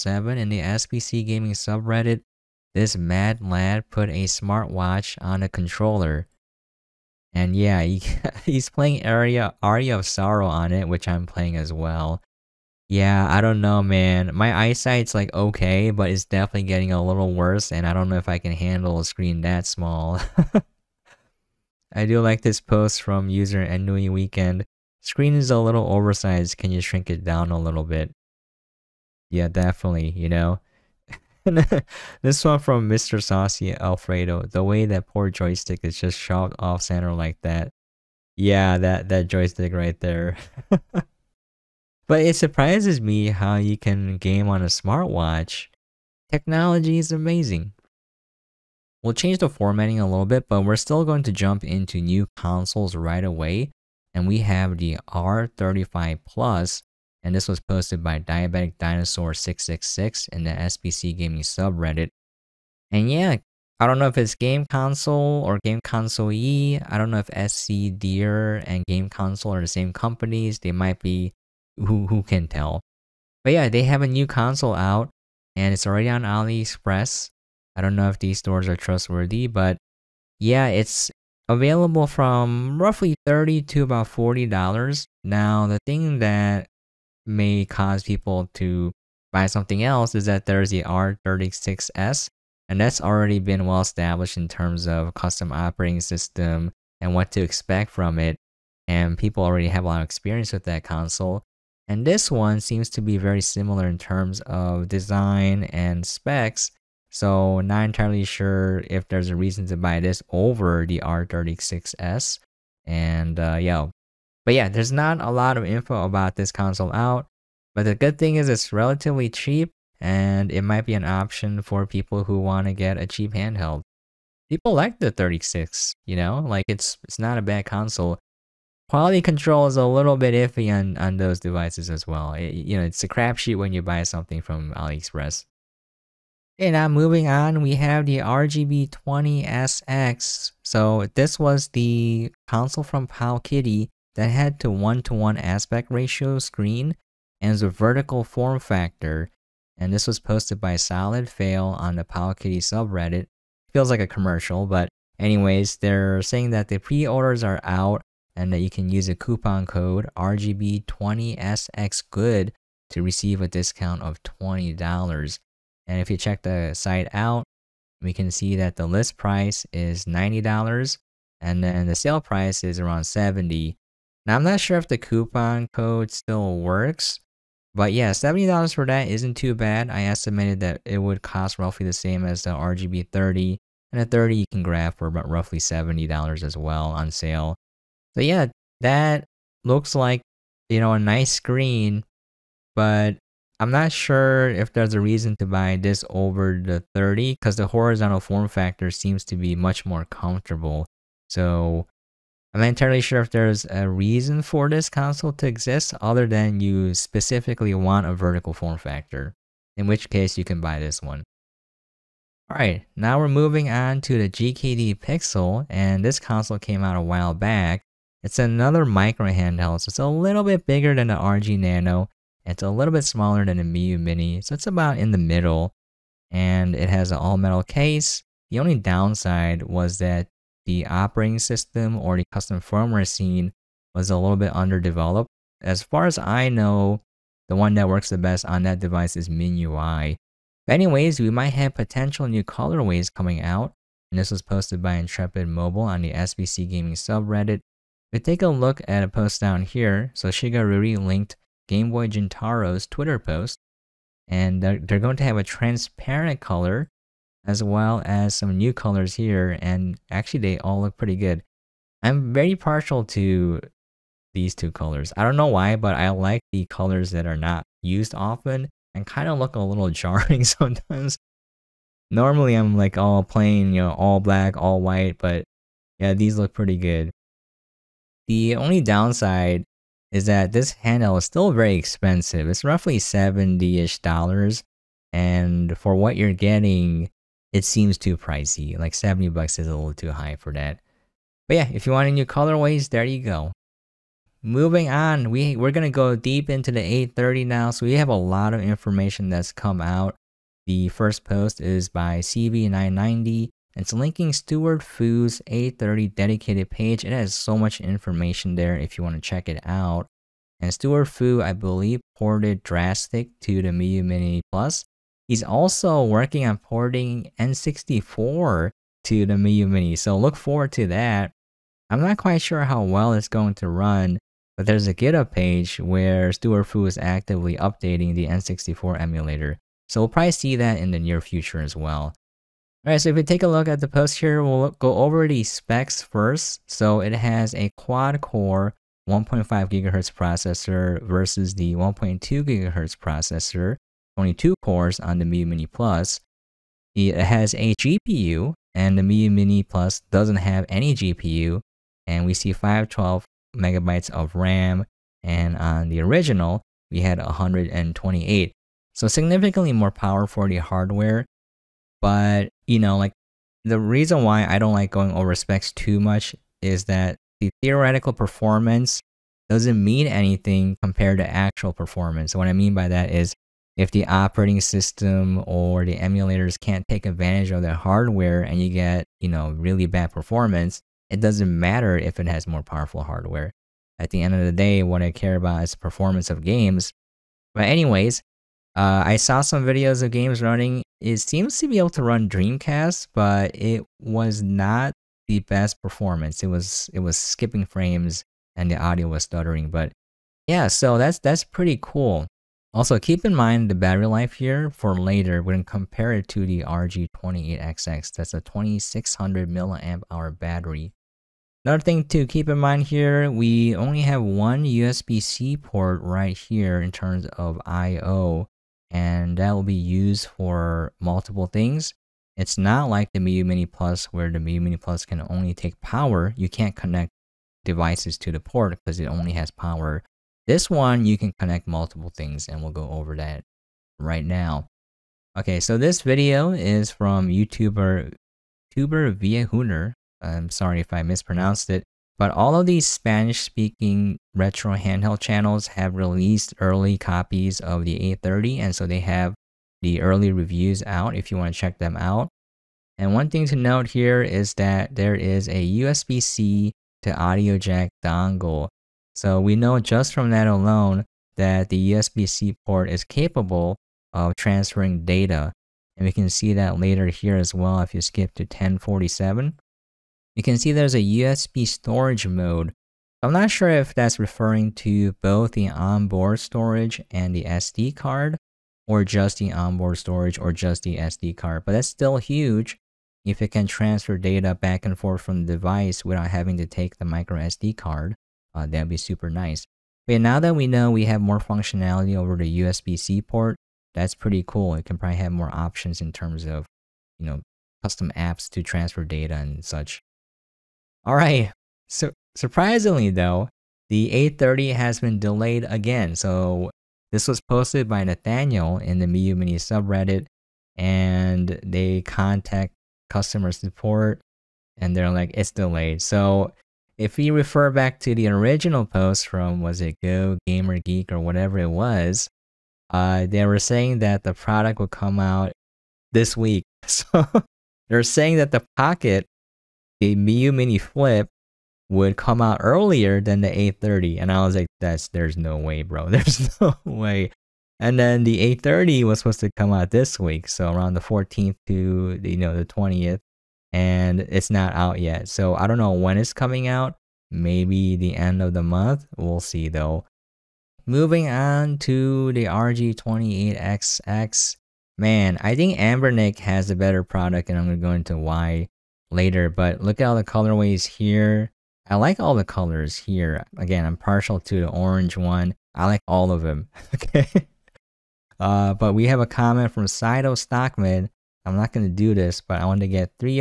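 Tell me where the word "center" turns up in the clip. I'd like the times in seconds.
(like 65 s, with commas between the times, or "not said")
36 s.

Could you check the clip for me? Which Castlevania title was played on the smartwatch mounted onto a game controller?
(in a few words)
Aria of Sorrow.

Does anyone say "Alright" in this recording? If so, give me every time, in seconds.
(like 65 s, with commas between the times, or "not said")
212 s, 332 s.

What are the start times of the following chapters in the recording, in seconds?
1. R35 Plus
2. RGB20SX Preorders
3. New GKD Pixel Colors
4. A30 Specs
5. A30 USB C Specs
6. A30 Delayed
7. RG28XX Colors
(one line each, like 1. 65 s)
1. 48 s
2. 137 s
3. 212 s
4. 295 s
5. 435 s
6. 501 s
7. 550 s.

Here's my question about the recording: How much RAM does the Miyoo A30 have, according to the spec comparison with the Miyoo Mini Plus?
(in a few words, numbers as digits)
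512 megabytes.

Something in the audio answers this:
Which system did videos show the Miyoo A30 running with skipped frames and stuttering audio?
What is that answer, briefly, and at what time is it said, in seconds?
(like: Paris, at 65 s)
Dreamcast, at 392 s.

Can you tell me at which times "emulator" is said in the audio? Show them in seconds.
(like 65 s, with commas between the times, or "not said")
328 s, 375 s.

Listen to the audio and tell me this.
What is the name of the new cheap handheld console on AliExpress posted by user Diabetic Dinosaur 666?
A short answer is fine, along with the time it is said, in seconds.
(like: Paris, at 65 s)
R35 Plus, at 55 s.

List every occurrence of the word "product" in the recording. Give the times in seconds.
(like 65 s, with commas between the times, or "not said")
524 s, 557 s.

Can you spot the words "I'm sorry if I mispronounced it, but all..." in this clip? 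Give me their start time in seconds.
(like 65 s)
440 s.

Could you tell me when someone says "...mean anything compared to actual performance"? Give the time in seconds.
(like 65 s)
369 s.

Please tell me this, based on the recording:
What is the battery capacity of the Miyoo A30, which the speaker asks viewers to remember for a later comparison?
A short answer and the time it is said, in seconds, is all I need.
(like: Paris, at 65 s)
2600 milliamp hour, at 408 s.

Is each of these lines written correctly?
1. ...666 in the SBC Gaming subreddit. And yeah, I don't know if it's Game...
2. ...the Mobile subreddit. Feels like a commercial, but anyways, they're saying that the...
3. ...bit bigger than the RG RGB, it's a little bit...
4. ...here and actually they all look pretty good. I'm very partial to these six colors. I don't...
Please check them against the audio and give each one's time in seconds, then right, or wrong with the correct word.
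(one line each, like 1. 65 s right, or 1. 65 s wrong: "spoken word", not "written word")
1. 59 s right
2. 151 s wrong: "Powkiddy", not "Mobile"
3. 220 s wrong: "Nano", not "RGB"
4. 259 s wrong: "two", not "six".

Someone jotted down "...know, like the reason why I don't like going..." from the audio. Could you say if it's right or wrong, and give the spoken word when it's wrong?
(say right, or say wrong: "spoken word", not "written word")
right.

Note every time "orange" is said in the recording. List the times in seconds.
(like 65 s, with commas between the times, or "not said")
564 s.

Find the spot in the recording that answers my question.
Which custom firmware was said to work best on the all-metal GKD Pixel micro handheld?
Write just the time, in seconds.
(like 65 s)
239 s.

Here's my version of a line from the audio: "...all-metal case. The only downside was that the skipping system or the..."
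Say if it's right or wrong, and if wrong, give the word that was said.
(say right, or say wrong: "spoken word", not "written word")
wrong: "operating", not "skipping".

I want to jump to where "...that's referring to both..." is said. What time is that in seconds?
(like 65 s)
473 s.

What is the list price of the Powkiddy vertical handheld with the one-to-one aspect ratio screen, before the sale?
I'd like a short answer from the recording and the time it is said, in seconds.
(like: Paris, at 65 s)
$90, at 170 s.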